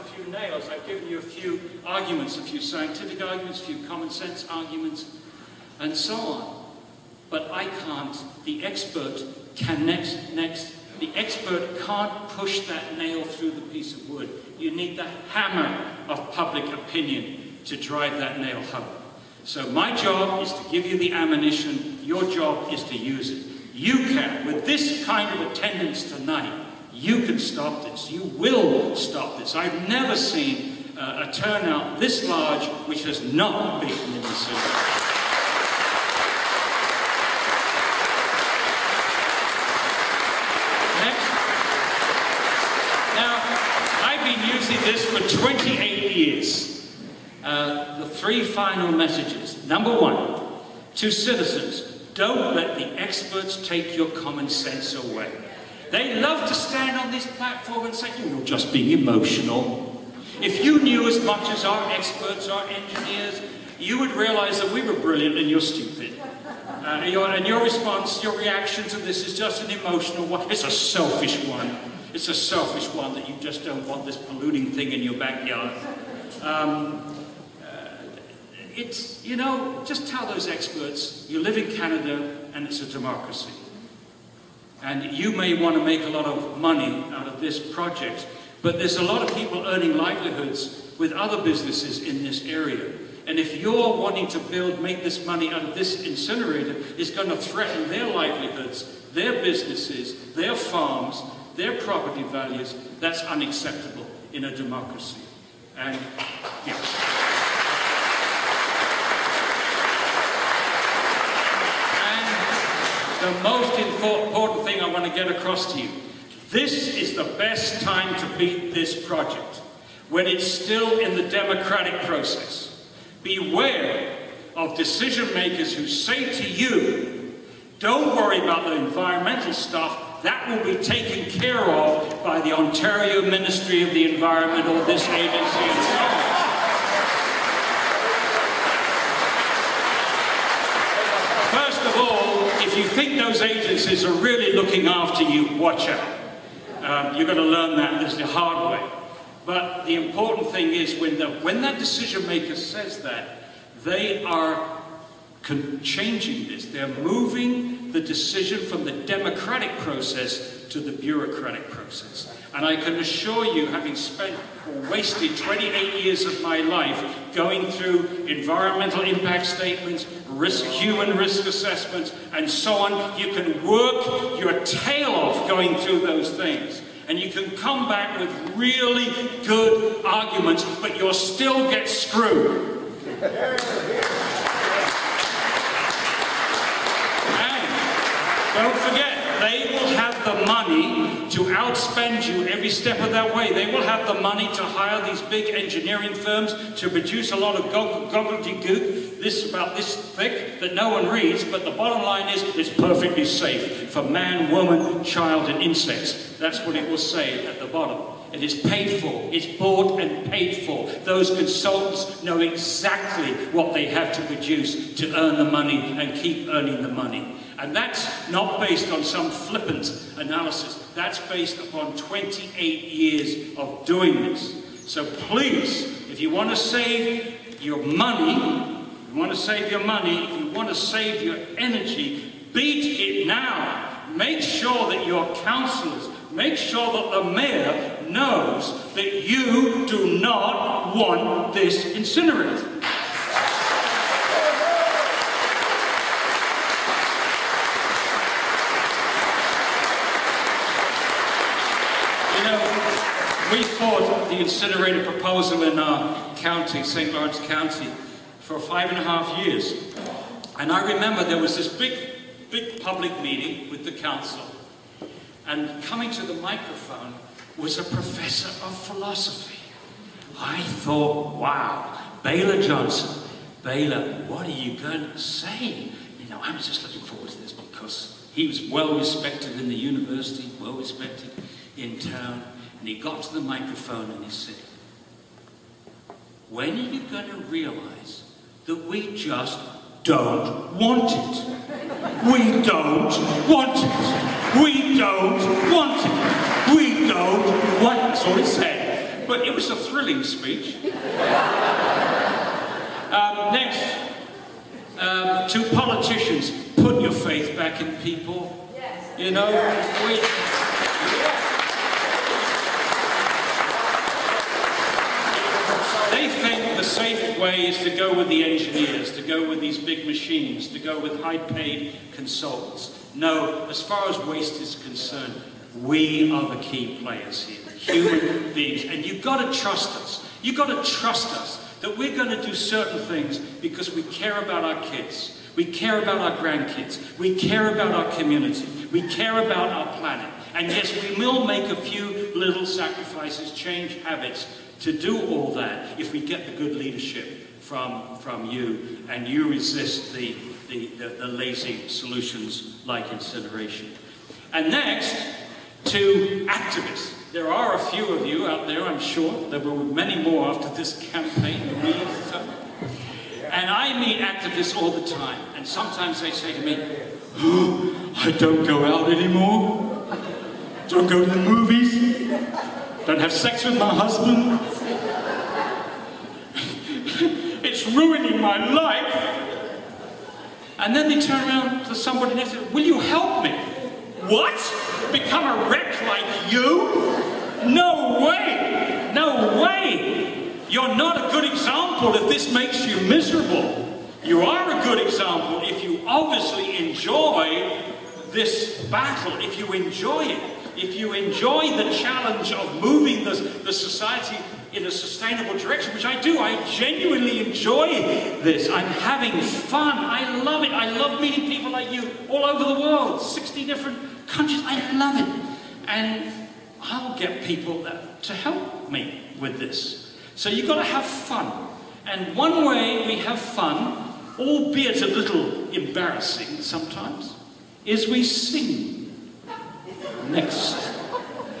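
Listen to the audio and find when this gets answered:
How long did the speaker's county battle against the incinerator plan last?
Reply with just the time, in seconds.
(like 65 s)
258 s.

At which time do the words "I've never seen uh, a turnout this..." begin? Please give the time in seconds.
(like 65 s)
29 s.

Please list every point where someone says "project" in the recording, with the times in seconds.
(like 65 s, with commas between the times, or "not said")
87 s, 119 s.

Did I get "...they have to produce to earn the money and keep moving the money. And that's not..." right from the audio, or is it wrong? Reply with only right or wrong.
wrong.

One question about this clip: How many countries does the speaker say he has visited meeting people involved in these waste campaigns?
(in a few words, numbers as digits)
60.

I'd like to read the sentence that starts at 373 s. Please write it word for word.
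Don't have sex with my husband.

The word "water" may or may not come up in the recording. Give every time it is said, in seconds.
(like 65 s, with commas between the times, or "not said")
not said.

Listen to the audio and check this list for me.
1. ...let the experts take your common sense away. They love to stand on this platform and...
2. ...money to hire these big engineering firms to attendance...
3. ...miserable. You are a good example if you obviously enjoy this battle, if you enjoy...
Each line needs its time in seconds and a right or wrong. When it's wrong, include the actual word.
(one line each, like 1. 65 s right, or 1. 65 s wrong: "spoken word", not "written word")
1. 52 s right
2. 194 s wrong: "produce", not "attendance"
3. 393 s right.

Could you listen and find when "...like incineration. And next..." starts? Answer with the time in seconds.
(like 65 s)
352 s.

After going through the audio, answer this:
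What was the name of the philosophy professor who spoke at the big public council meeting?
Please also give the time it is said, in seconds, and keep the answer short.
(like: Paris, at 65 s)
Baylor Johnson, at 272 s.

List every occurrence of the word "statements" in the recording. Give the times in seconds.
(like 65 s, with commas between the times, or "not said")
169 s.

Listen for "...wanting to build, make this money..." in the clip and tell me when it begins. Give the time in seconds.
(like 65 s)
93 s.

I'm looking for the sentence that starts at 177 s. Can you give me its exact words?
And you can come back with really good arguments, but you'll still get screwed.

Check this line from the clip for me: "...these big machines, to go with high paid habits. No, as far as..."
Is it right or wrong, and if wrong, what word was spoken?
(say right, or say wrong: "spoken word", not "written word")
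wrong: "consultants", not "habits".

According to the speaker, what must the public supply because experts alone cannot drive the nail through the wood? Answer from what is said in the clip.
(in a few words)
hammer of public opinion.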